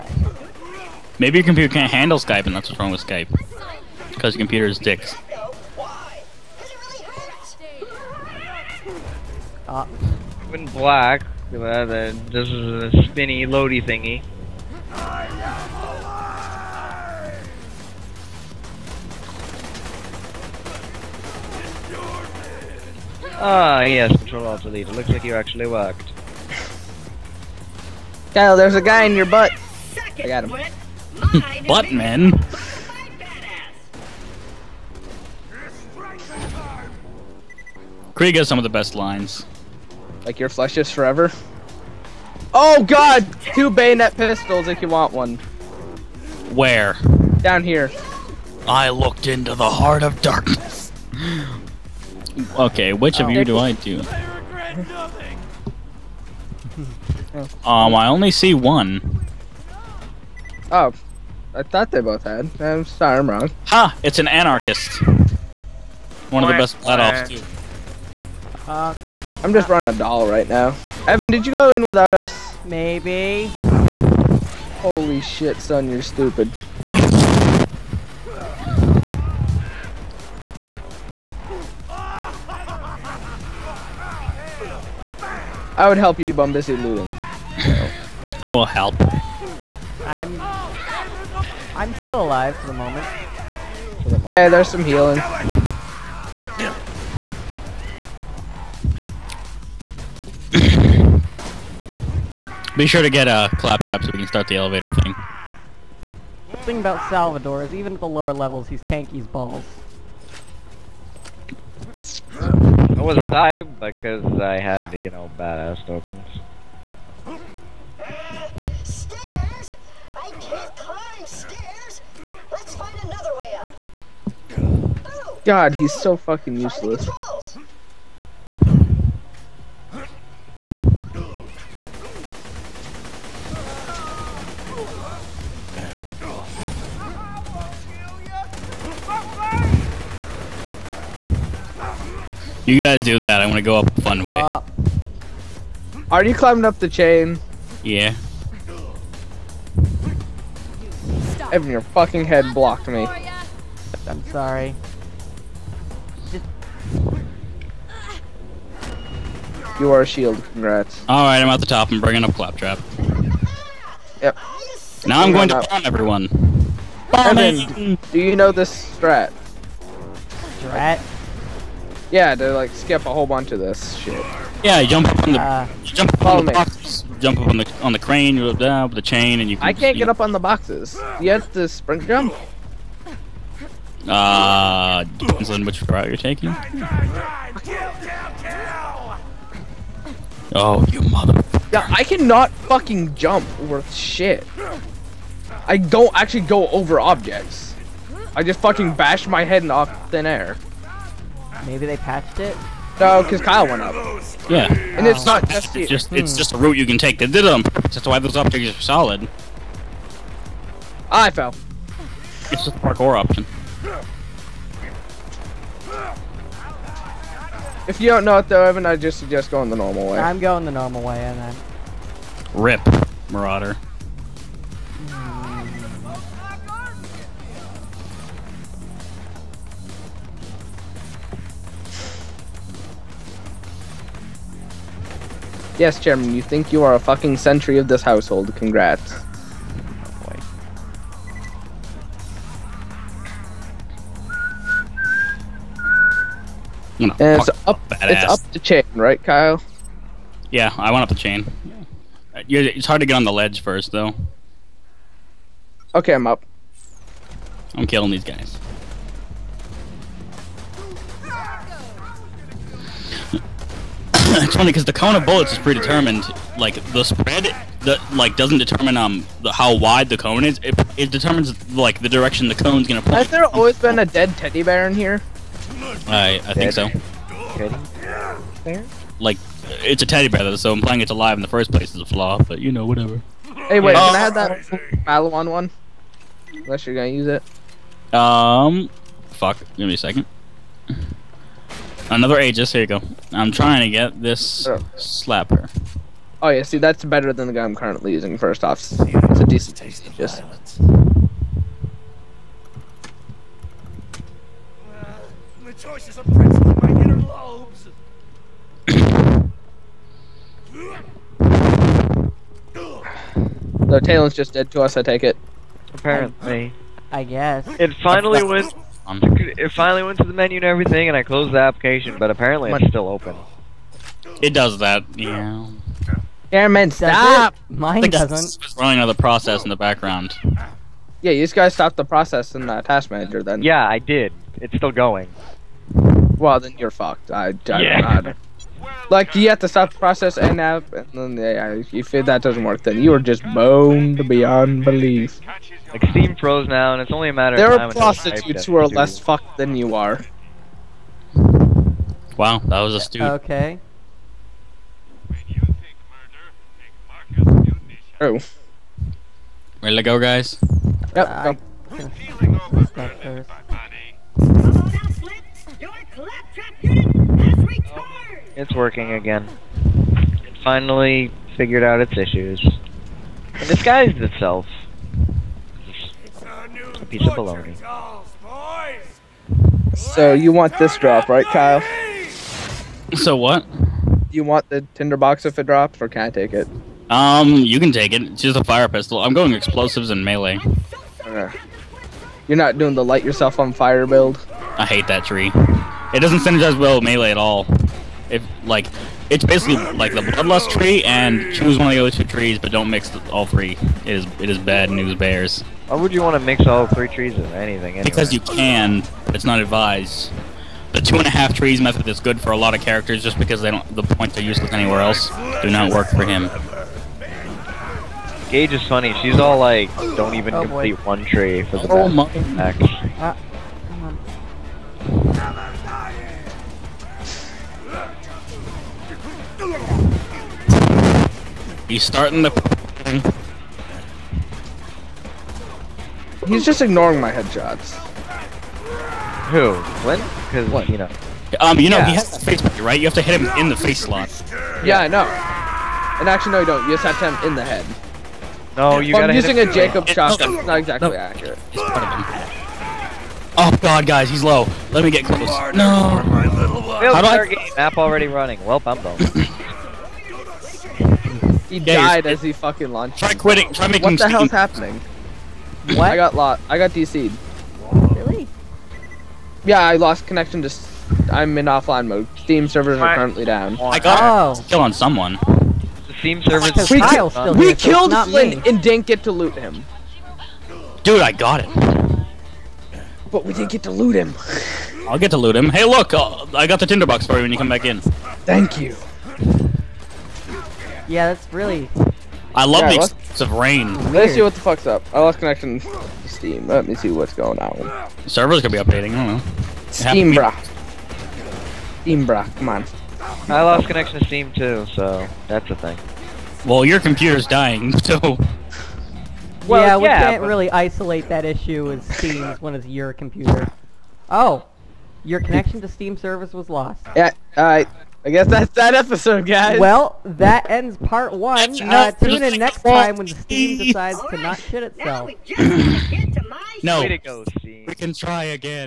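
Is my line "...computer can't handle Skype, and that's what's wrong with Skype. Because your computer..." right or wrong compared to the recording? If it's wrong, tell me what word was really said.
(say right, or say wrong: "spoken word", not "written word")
right.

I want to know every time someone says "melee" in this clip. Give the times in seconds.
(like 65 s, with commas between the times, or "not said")
390 s, 397 s.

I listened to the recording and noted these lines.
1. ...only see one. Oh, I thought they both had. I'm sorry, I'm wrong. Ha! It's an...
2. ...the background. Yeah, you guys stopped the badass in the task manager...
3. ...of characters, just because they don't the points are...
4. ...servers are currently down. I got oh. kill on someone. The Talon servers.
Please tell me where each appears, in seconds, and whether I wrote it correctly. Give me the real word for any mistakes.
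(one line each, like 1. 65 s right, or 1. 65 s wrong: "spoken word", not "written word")
1. 58 s right
2. 329 s wrong: "process", not "badass"
3. 412 s right
4. 472 s wrong: "Steam", not "Talon".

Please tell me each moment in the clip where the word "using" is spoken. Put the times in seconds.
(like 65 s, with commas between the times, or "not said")
298 s, 449 s.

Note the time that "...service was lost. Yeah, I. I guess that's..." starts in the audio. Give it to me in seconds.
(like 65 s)
516 s.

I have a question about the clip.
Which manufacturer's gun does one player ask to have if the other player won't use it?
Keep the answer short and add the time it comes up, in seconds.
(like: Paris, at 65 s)
Maliwan, at 285 s.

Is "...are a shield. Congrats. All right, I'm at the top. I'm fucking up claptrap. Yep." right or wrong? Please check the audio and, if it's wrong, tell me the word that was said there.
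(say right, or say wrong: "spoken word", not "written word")
wrong: "bringing", not "fucking".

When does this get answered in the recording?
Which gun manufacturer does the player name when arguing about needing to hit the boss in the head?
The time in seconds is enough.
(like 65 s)
449 s.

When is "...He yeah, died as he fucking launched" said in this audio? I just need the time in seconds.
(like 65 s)
461 s.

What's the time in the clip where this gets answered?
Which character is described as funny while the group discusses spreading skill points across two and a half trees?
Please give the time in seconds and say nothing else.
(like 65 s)
418 s.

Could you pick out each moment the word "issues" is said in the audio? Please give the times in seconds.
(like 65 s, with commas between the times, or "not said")
372 s, 511 s.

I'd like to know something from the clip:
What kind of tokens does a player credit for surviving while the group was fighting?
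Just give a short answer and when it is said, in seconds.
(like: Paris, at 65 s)
badass tokens, at 115 s.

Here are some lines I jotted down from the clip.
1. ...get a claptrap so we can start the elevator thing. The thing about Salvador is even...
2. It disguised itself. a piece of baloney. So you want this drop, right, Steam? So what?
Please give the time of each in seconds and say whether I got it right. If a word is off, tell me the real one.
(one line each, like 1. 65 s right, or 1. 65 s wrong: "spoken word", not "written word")
1. 103 s right
2. 372 s wrong: "Kyle", not "Steam".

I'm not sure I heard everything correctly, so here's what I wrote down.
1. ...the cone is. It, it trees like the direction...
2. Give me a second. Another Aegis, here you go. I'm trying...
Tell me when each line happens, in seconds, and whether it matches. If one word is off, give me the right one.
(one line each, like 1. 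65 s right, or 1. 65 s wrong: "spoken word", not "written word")
1. 270 s wrong: "determines", not "trees"
2. 289 s right.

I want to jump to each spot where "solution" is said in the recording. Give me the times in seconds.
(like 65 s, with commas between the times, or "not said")
not said.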